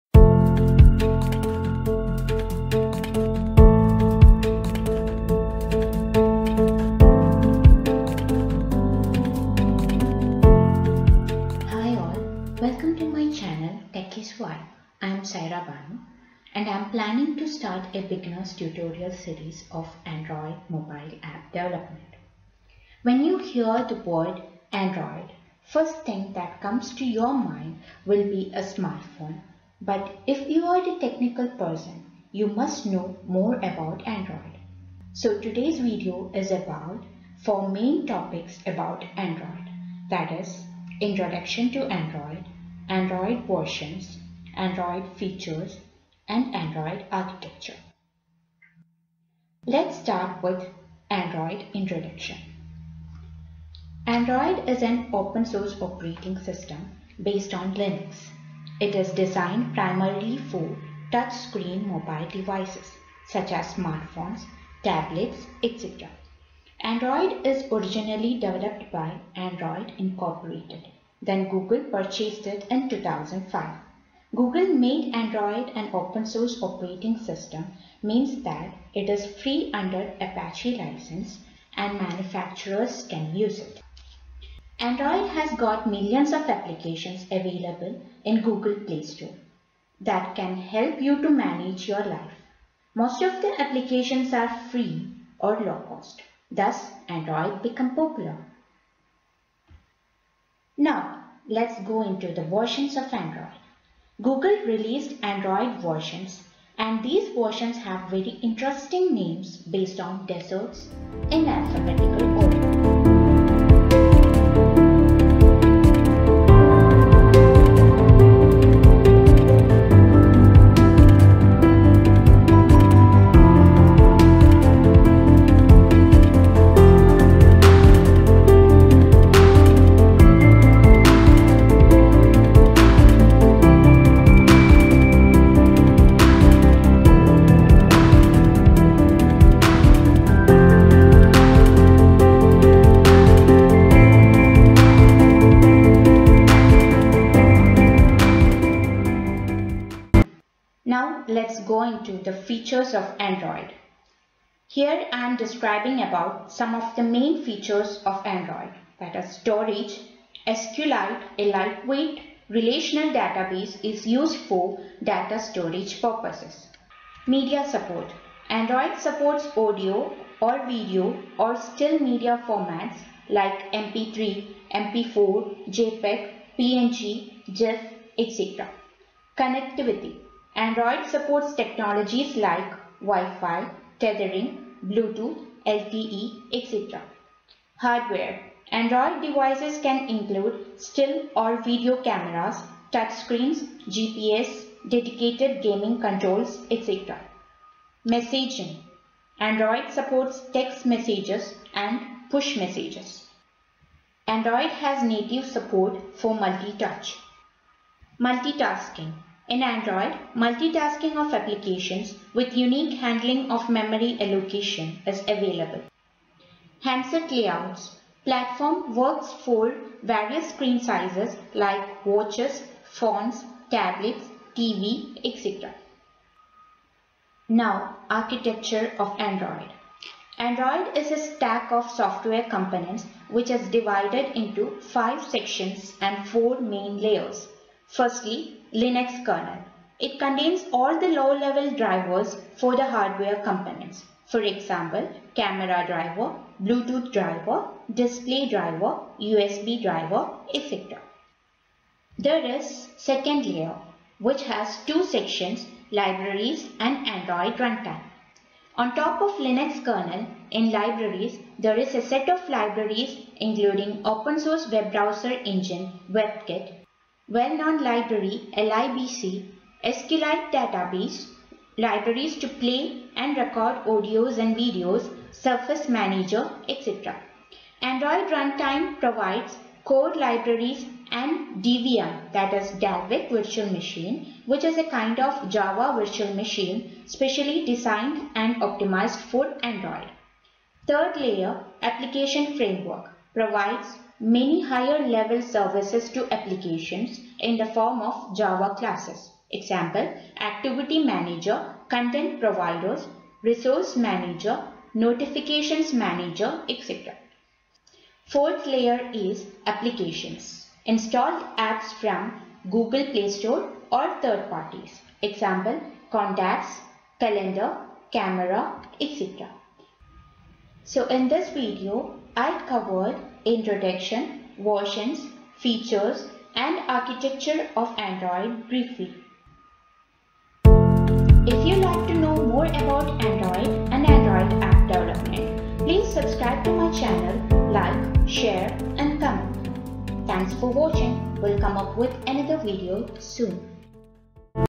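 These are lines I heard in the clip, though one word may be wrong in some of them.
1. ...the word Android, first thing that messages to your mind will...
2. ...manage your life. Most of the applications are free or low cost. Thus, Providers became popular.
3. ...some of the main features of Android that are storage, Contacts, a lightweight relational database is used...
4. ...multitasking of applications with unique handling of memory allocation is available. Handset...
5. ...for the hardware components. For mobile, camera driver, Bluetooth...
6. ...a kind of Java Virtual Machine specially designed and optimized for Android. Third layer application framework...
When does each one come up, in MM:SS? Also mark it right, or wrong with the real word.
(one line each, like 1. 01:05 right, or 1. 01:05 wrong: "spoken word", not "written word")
1. 00:23 wrong: "comes", not "messages"
2. 01:31 wrong: "Android", not "Providers"
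3. 02:36 wrong: "SQLite", not "Contacts"
4. 03:30 right
5. 04:02 wrong: "example", not "mobile"
6. 04:44 right.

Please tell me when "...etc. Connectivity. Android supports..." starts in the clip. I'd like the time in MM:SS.
02:58.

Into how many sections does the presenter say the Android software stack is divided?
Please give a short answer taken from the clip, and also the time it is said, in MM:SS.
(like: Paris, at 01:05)
5, at 03:54.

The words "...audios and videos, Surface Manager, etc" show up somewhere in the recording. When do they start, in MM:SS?
04:33.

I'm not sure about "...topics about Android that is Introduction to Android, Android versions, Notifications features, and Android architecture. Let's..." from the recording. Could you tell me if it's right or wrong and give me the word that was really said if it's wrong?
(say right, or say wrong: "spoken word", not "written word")
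wrong: "Android", not "Notifications".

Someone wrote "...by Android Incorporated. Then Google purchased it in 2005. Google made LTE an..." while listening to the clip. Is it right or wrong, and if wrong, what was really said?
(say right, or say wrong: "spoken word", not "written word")
wrong: "Android", not "LTE".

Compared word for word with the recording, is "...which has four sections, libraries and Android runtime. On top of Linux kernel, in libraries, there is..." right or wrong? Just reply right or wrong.
wrong.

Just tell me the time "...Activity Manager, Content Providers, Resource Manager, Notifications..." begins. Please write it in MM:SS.
05:00.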